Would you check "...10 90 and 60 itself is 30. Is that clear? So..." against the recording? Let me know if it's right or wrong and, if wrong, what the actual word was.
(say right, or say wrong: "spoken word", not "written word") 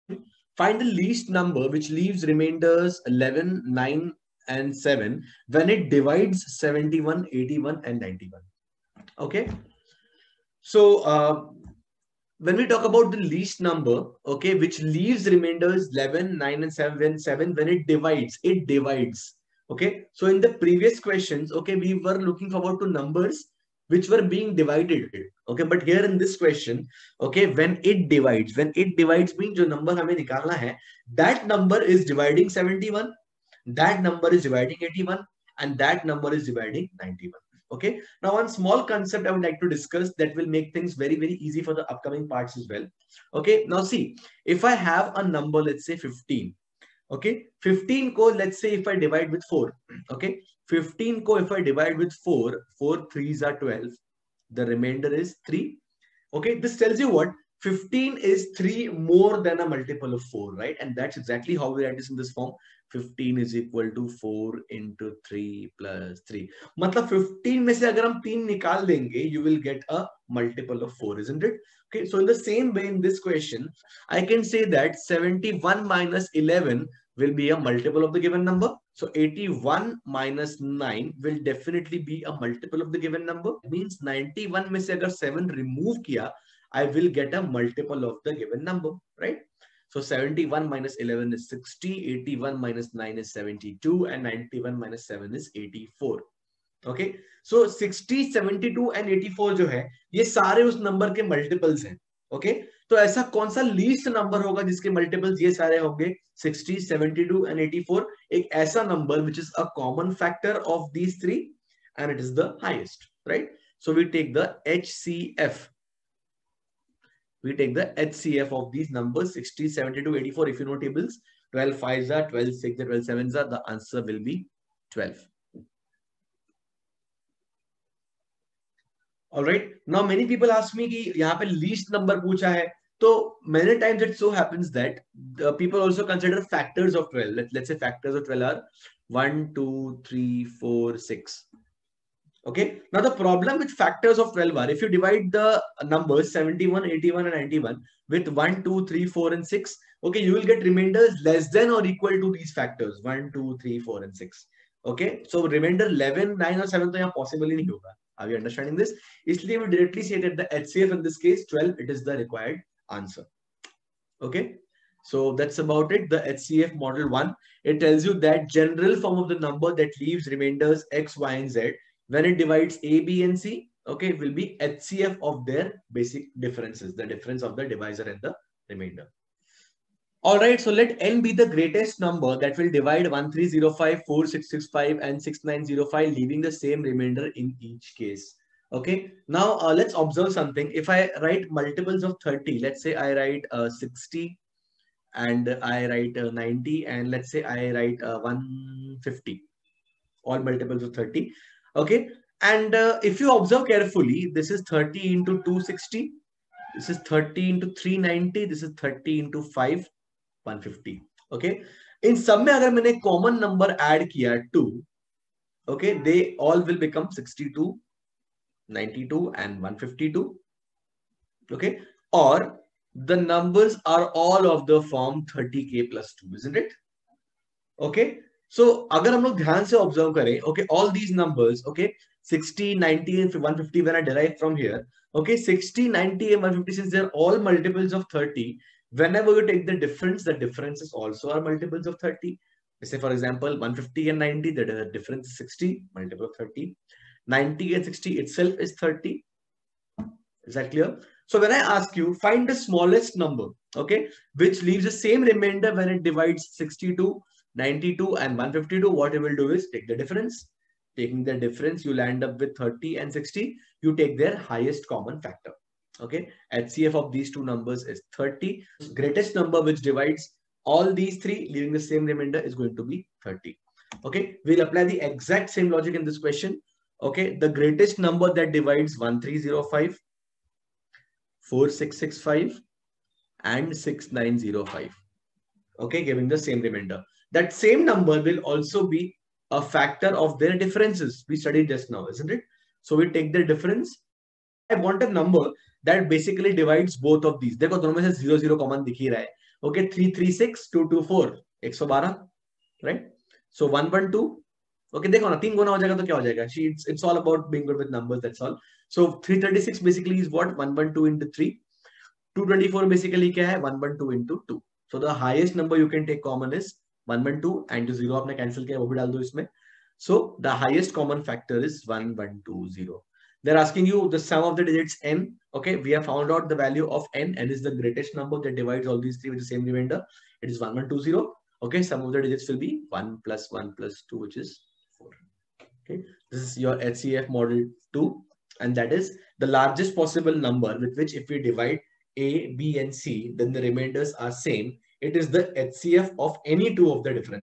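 wrong: "30", not "10".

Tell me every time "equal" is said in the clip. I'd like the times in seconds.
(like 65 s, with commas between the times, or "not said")
63 s, 151 s.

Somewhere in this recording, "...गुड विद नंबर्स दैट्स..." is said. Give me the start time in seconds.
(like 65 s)
307 s.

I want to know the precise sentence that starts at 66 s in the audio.
मतलब 15 में से अगर हम 3 निकाल देंगे, you will get a multiple of 4, isn't it?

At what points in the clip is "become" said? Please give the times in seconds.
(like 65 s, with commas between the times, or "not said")
216 s.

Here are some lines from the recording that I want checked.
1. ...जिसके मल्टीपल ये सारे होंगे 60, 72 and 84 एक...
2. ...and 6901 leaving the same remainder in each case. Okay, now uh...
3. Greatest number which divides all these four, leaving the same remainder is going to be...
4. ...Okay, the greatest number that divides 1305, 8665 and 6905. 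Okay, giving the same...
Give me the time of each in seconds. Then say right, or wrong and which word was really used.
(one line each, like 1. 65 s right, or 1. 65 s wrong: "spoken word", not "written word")
1. 104 s right
2. 185 s wrong: "6905", not "6901"
3. 268 s wrong: "three", not "four"
4. 277 s wrong: "4665", not "8665".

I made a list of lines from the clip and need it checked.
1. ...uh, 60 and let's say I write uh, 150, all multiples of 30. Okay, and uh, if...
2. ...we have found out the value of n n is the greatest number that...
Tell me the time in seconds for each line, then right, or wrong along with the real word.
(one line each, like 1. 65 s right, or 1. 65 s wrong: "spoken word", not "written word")
1. 196 s wrong: "90", not "60"
2. 325 s right.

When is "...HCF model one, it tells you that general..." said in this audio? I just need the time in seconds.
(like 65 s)
166 s.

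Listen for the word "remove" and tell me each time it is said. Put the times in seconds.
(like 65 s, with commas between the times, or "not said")
85 s.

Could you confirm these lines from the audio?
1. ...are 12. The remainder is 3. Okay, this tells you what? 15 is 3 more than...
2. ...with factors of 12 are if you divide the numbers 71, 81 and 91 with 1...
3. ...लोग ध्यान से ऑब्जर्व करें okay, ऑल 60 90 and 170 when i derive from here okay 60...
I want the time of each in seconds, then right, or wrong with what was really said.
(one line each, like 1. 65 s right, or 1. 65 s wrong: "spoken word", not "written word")
1. 53 s right
2. 143 s right
3. 229 s wrong: "150", not "170".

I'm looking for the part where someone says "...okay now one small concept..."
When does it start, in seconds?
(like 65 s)
37 s.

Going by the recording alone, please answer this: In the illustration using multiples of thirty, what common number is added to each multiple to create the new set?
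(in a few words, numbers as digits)
2.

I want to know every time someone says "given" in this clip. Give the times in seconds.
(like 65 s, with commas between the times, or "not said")
78 s, 83 s, 88 s.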